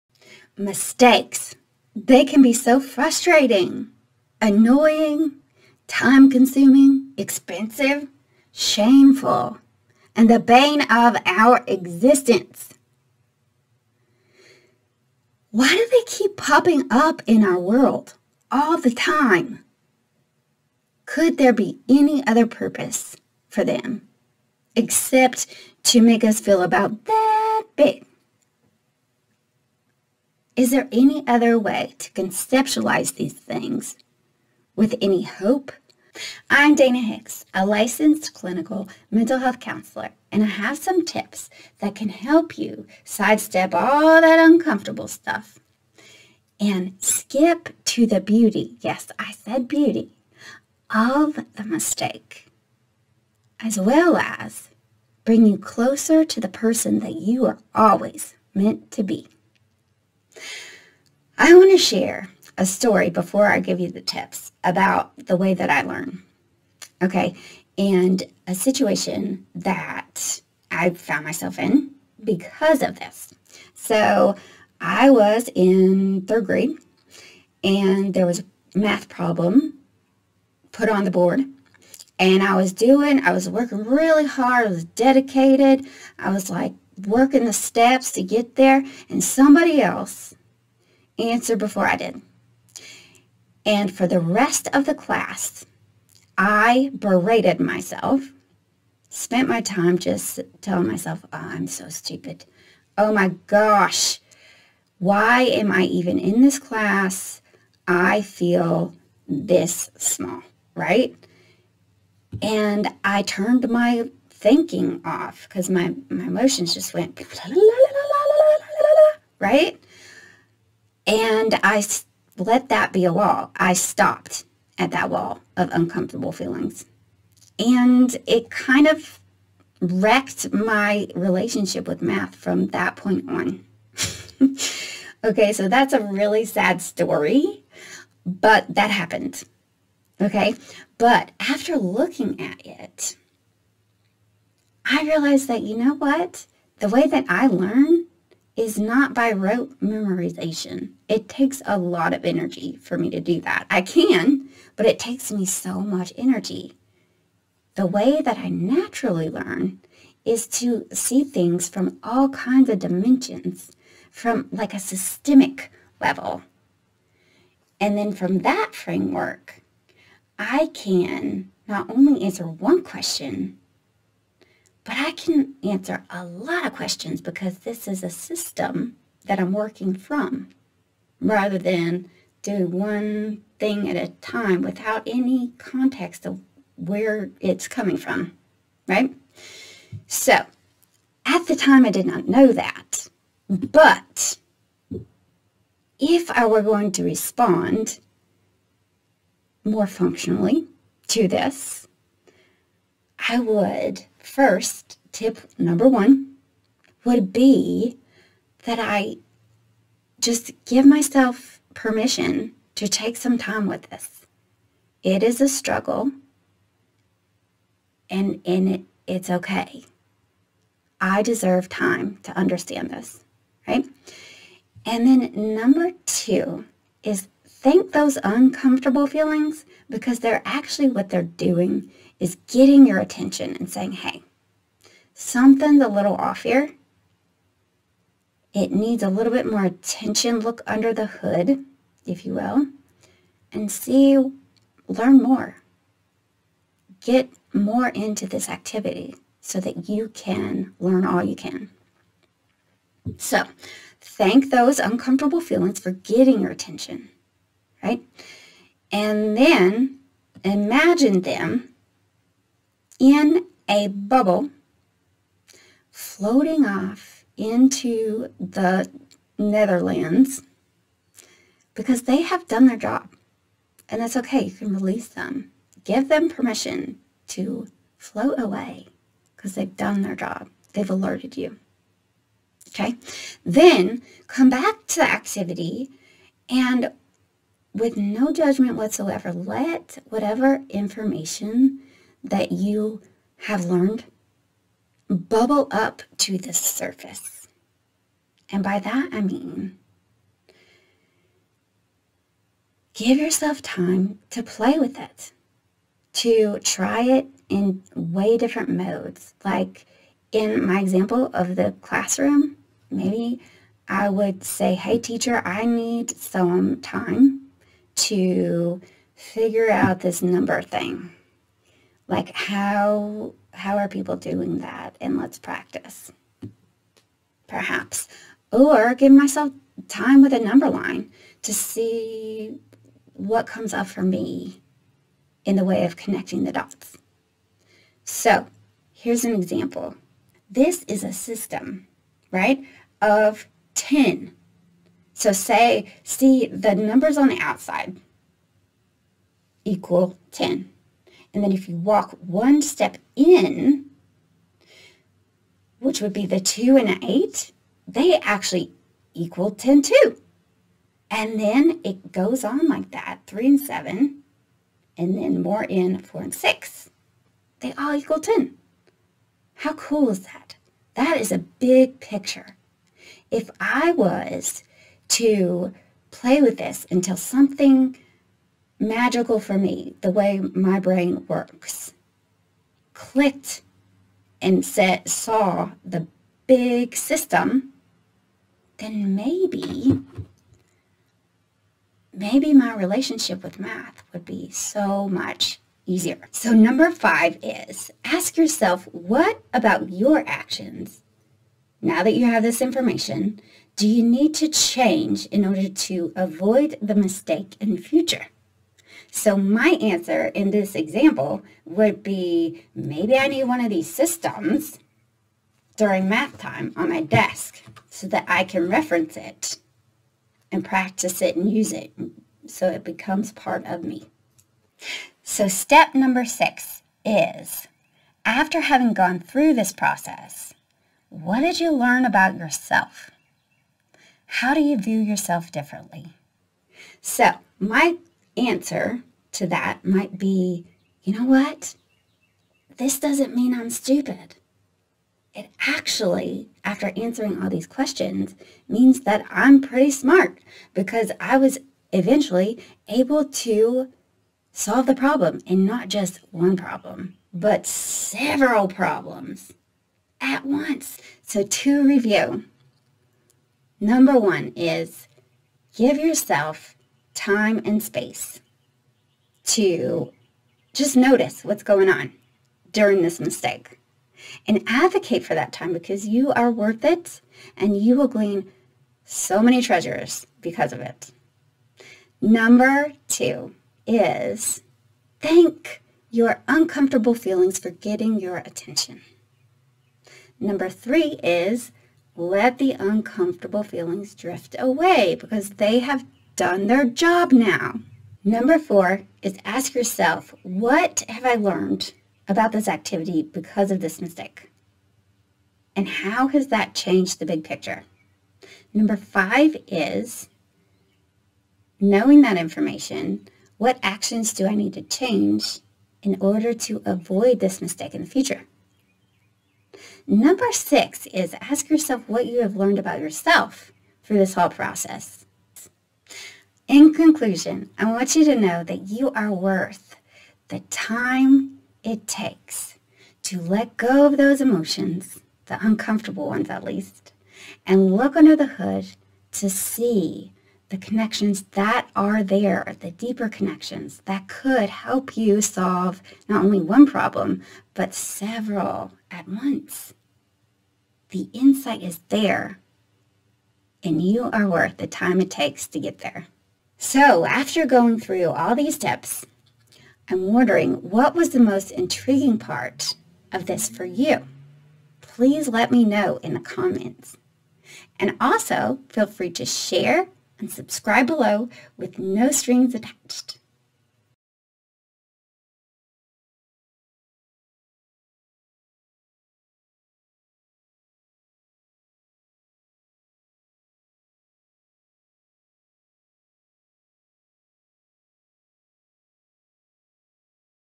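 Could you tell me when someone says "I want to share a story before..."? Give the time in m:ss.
1:01.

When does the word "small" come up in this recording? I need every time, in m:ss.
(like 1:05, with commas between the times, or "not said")
1:49.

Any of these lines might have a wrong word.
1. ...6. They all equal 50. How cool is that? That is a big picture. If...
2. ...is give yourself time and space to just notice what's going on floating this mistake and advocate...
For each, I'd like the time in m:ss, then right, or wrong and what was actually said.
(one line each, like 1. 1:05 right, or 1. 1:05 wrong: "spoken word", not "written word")
1. 6:06 wrong: "10", not "50"
2. 7:44 wrong: "during", not "floating".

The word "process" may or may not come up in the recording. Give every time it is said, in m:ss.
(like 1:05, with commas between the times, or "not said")
7:09, 8:44.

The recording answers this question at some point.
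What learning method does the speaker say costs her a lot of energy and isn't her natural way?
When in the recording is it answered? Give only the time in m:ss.
2:29.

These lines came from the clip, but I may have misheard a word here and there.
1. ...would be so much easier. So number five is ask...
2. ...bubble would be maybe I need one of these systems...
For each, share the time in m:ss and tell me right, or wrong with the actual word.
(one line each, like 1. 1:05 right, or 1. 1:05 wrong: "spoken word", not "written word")
1. 6:34 right
2. 6:50 wrong: "example", not "bubble".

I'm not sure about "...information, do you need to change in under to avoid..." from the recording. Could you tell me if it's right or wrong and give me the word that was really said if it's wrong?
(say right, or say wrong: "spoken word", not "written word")
wrong: "order", not "under".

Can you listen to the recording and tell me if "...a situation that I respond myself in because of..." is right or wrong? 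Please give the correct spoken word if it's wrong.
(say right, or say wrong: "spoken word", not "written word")
wrong: "found", not "respond".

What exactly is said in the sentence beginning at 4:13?
So, thank those uncomfortable feelings for getting your attention right?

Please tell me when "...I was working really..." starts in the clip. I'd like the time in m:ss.
1:23.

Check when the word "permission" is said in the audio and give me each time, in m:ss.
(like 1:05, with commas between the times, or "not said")
3:31, 4:36.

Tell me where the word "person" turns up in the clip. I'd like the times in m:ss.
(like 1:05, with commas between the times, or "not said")
0:56.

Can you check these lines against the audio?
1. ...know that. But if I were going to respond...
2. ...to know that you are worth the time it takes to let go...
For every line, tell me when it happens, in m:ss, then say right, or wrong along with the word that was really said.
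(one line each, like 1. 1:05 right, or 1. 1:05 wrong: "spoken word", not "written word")
1. 3:12 right
2. 8:48 right.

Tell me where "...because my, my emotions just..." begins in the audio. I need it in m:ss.
1:55.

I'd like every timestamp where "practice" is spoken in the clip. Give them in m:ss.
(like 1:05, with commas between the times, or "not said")
5:25, 7:00.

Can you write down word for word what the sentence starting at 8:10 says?
Number three is let the uncomfortable feelings drift away because they have done their job now.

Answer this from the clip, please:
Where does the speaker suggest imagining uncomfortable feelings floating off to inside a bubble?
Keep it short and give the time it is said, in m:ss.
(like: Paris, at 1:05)
the Netherlands, at 4:28.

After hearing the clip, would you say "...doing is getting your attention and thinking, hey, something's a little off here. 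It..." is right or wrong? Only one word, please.
wrong.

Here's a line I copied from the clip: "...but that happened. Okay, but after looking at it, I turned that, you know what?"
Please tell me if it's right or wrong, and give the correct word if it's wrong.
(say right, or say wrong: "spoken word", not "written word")
wrong: "realized", not "turned".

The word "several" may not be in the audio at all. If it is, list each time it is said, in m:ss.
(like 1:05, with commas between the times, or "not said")
7:37, 9:07.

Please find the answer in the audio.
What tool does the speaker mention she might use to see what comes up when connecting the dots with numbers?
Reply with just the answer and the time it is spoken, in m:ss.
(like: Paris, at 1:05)
number line, at 5:30.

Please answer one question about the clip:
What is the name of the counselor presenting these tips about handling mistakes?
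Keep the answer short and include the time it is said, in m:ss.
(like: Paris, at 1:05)
Dana Hicks, at 0:36.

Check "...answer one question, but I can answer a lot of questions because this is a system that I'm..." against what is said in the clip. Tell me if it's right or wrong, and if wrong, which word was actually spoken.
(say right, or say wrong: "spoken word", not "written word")
right.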